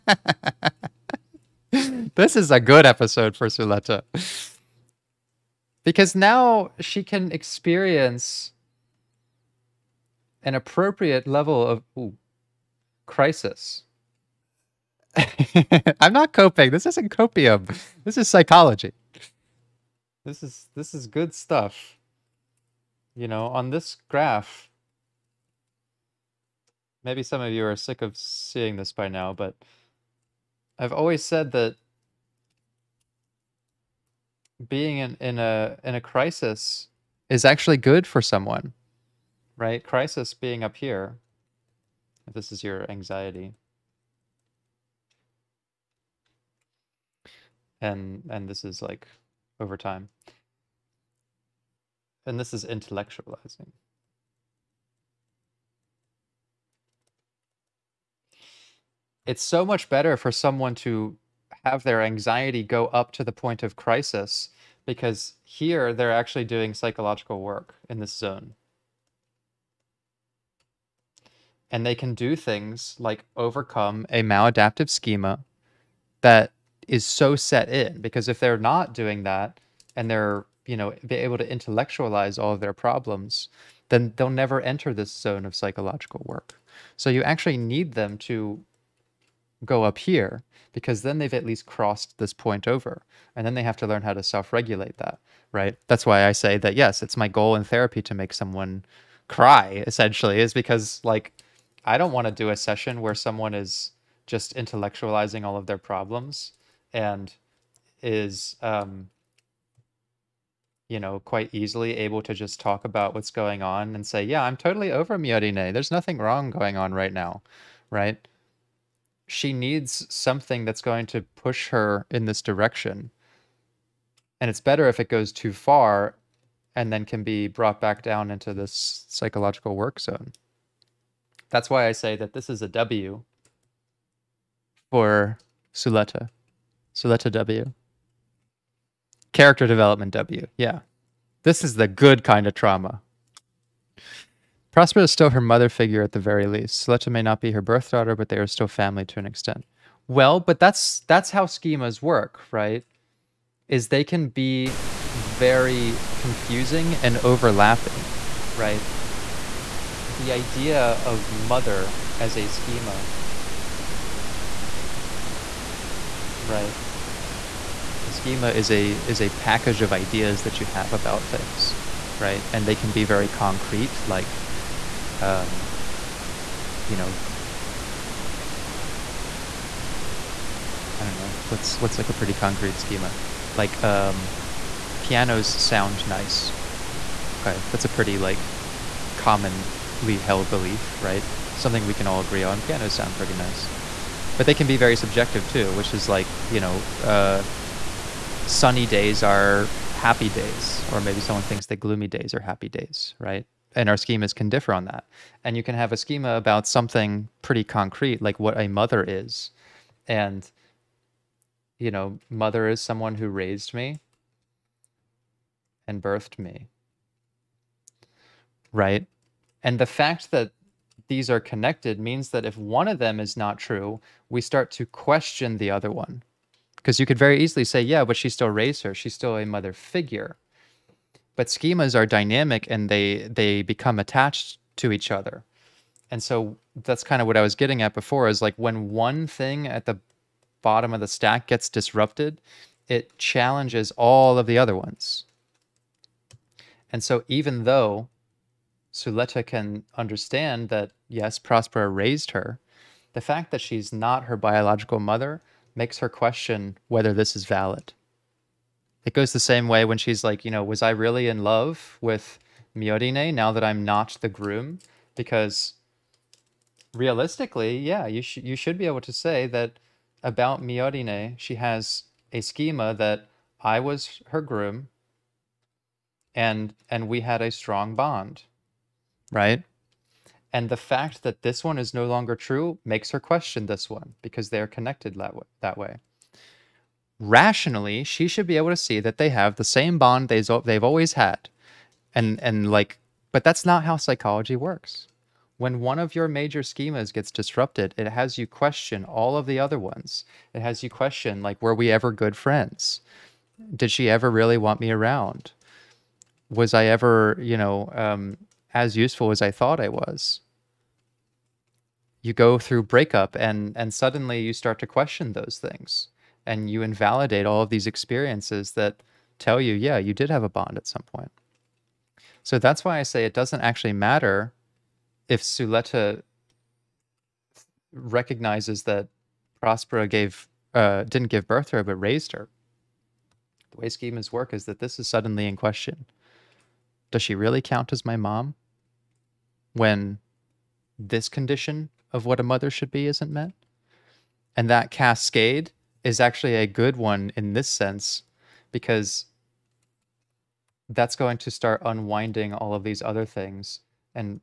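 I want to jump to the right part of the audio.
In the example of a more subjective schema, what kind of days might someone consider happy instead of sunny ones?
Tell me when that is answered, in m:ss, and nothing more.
3:21.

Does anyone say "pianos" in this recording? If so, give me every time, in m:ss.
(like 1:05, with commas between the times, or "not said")
3:05, 3:12.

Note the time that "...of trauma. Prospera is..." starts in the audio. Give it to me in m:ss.
2:22.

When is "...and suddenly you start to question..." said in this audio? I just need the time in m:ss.
5:13.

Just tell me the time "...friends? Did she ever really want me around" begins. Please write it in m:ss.
5:02.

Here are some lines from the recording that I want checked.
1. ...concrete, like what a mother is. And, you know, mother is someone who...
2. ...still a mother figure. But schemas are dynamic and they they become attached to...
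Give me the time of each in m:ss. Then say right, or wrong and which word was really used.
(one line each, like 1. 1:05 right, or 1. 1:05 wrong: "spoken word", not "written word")
1. 3:27 right
2. 3:49 right.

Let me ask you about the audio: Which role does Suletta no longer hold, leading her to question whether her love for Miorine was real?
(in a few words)
The groom.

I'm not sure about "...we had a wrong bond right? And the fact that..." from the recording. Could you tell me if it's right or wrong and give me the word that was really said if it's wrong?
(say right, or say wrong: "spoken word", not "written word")
wrong: "strong", not "wrong".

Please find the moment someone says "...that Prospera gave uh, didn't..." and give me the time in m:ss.
5:28.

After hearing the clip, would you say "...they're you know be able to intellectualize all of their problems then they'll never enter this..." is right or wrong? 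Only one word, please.
right.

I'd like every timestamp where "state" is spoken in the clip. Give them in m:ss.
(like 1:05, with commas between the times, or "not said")
not said.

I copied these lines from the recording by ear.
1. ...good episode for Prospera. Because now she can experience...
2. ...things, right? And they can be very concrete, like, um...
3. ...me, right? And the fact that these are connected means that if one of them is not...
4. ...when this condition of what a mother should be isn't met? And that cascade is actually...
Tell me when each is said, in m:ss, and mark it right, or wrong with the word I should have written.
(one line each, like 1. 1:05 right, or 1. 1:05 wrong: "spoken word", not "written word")
1. 0:02 wrong: "Suletta", not "Prospera"
2. 2:51 right
3. 3:36 right
4. 5:39 right.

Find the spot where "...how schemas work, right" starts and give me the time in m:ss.
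2:31.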